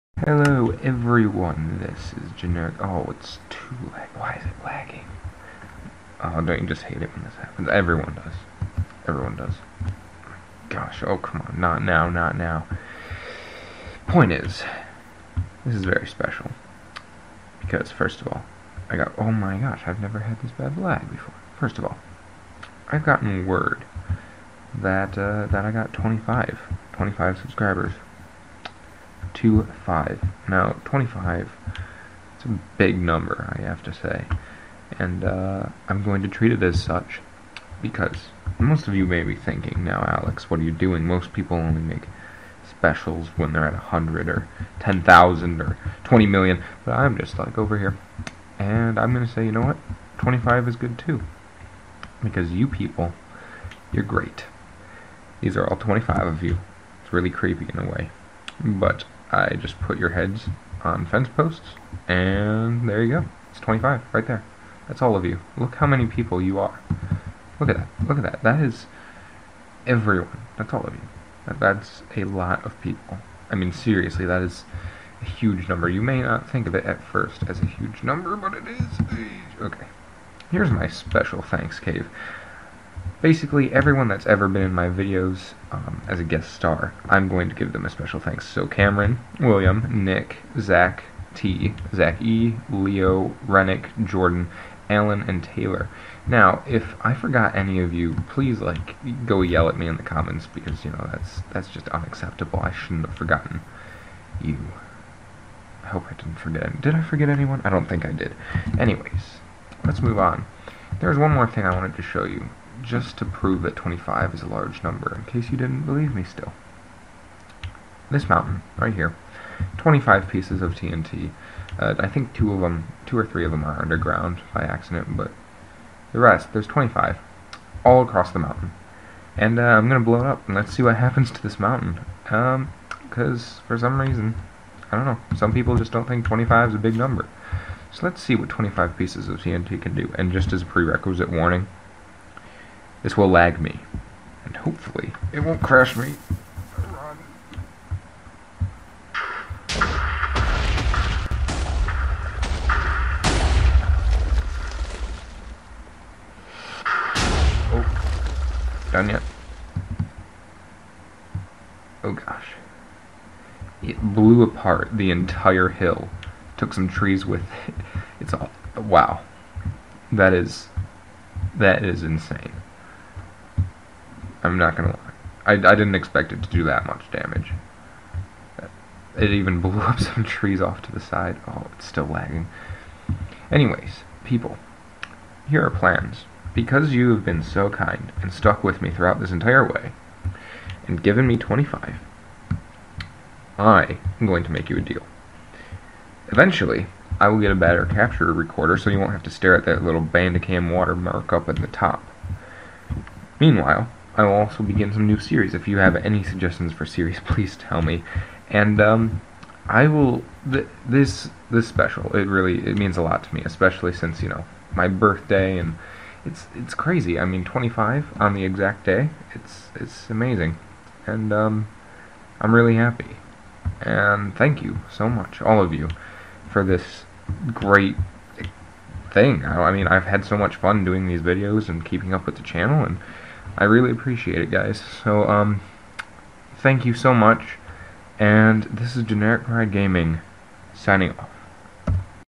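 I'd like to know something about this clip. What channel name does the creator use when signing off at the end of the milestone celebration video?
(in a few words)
Generic Pride Gaming.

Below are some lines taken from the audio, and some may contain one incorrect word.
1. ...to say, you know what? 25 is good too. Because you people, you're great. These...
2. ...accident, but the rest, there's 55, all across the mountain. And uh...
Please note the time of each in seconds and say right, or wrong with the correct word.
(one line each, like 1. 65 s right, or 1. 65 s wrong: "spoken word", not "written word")
1. 49 s right
2. 124 s wrong: "25", not "55".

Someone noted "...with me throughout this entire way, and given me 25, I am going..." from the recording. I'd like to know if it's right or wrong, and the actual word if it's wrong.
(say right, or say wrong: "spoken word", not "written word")
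right.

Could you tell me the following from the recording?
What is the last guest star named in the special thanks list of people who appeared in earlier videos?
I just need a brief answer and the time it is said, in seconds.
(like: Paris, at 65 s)
Taylor, at 95 s.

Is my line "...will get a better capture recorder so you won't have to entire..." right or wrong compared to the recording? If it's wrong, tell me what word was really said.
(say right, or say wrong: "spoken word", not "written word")
wrong: "stare", not "entire".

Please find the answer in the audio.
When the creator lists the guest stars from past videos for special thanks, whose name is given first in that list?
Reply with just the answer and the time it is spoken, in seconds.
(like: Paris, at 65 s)
Cameron, at 88 s.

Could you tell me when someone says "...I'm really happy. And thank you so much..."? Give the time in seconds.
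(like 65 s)
222 s.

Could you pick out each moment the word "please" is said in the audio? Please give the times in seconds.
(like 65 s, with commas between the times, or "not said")
98 s, 207 s.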